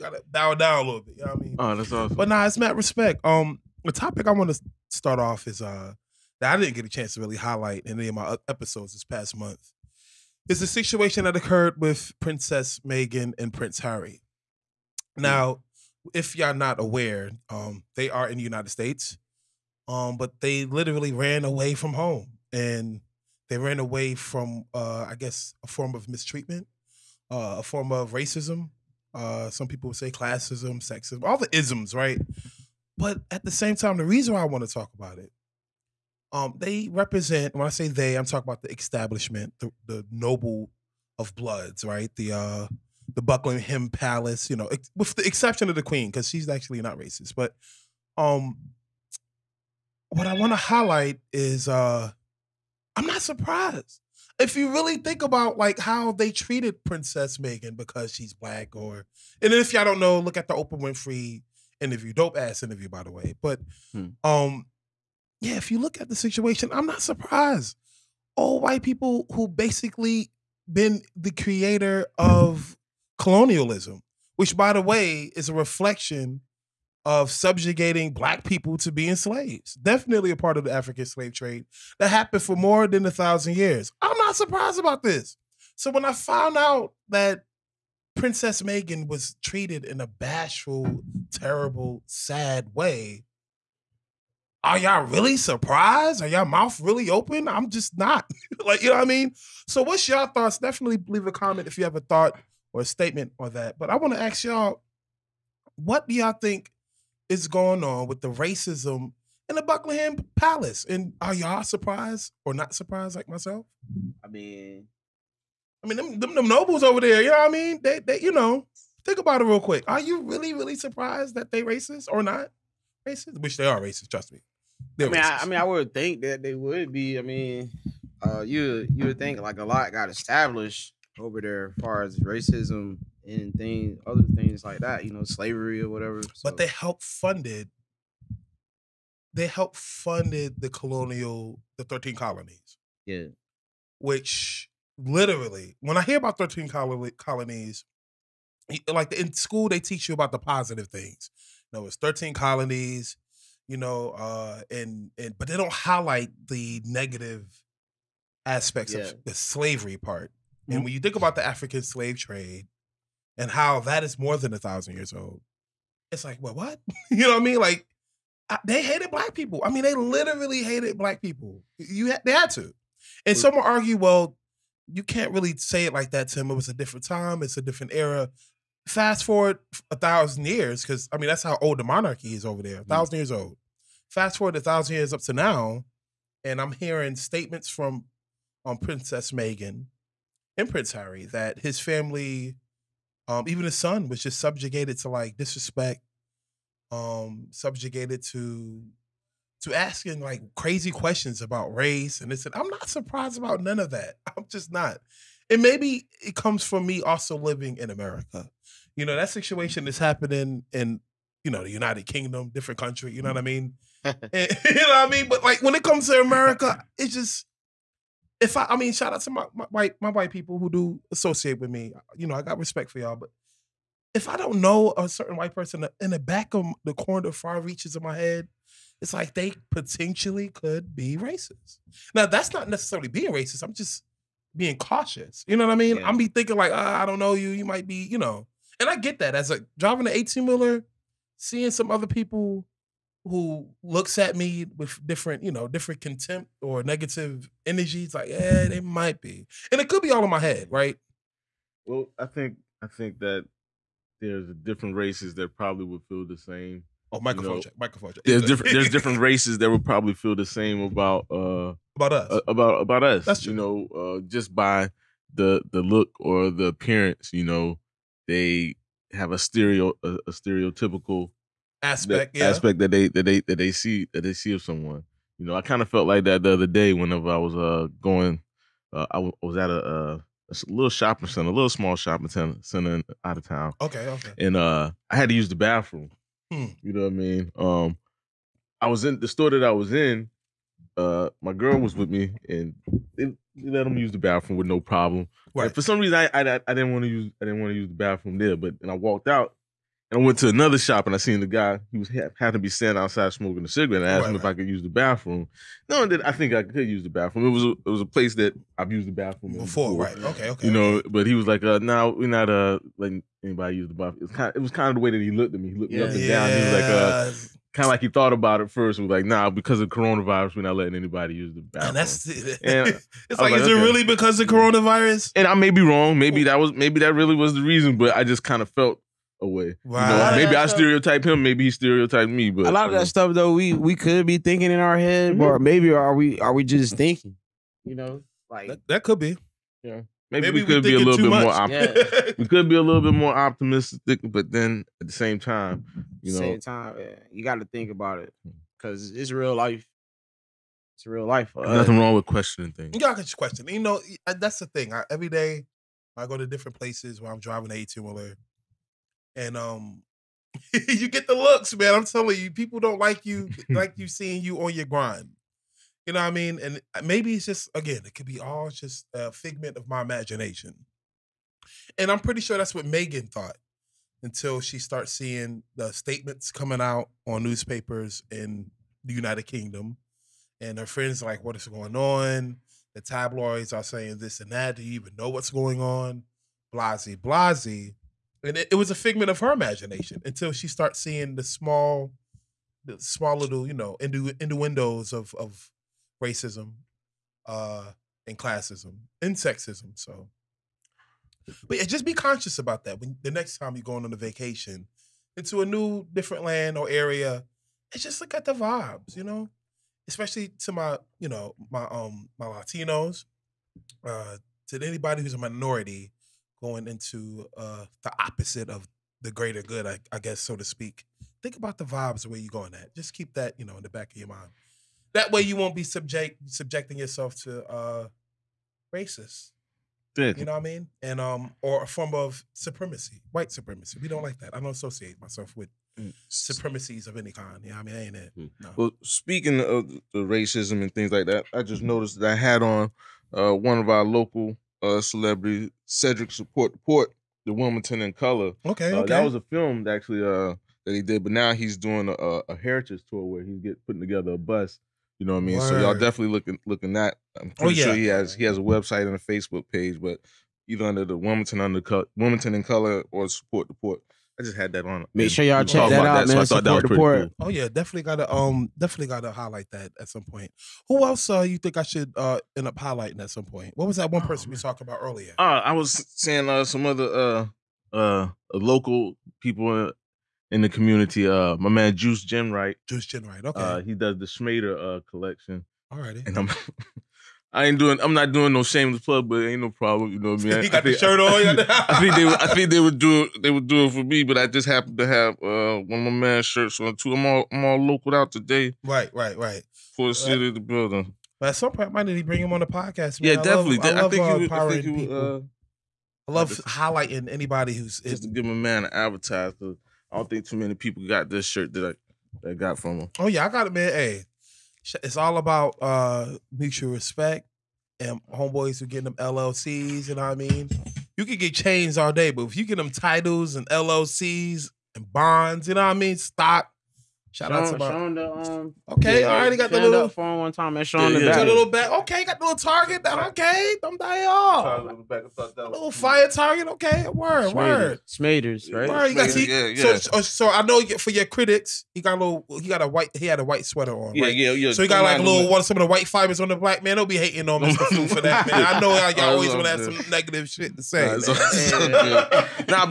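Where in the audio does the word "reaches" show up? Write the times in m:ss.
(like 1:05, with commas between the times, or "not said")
3:47.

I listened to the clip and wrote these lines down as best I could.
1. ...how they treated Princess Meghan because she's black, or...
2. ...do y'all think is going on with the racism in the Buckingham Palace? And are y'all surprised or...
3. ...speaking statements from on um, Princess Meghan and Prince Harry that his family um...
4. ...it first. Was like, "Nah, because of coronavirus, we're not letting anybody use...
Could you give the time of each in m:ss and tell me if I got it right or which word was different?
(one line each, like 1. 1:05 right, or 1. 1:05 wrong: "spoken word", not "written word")
1. 0:55 right
2. 1:46 right
3. 3:06 wrong: "hearing", not "speaking"
4. 5:18 right.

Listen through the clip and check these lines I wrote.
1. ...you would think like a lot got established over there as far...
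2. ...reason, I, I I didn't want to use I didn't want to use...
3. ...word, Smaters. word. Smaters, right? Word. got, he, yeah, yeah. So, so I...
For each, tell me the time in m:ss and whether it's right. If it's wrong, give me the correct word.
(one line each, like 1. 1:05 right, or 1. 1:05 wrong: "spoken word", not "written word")
1. 2:08 right
2. 4:55 right
3. 8:57 right.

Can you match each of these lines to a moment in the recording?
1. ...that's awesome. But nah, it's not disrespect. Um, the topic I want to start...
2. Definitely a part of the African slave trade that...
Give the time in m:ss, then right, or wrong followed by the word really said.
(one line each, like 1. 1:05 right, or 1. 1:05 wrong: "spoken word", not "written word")
1. 0:01 wrong: "respect", not "disrespect"
2. 1:19 right.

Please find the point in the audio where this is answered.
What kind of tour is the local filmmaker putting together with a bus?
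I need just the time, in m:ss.
7:32.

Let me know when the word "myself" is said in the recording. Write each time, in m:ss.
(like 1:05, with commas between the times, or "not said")
1:53, 7:15.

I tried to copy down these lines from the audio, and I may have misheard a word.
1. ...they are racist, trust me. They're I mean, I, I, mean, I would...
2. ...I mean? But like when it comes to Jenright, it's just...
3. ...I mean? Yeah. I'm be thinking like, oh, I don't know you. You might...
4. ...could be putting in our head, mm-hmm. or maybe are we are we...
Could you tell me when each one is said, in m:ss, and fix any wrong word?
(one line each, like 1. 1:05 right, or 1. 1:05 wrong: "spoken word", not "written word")
1. 2:03 right
2. 3:35 wrong: "America", not "Jenright"
3. 3:55 right
4. 5:33 wrong: "thinking", not "putting".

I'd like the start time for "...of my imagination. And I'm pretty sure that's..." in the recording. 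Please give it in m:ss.
6:09.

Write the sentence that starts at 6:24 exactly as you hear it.
Do you even know what's going on?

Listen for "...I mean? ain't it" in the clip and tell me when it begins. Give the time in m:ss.
7:17.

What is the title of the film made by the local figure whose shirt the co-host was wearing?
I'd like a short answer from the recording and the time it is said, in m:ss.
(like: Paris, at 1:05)
The Wilmington in Color, at 7:27.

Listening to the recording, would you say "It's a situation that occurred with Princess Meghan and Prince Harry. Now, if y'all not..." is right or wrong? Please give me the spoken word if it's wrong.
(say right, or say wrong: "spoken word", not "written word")
right.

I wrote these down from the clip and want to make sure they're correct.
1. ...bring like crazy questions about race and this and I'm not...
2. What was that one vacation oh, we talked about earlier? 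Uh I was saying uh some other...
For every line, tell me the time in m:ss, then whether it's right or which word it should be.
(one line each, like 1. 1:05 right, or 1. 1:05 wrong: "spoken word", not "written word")
1. 3:19 wrong: "asking", not "bring"
2. 7:53 wrong: "person", not "vacation".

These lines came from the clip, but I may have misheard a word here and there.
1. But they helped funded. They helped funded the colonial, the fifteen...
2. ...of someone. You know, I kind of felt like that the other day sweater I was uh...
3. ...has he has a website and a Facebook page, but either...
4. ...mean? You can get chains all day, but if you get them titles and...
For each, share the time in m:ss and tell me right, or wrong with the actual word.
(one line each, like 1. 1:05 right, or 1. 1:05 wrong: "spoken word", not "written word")
1. 2:16 wrong: "thirteen", not "fifteen"
2. 4:34 wrong: "whenever", not "sweater"
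3. 7:38 right
4. 8:40 right.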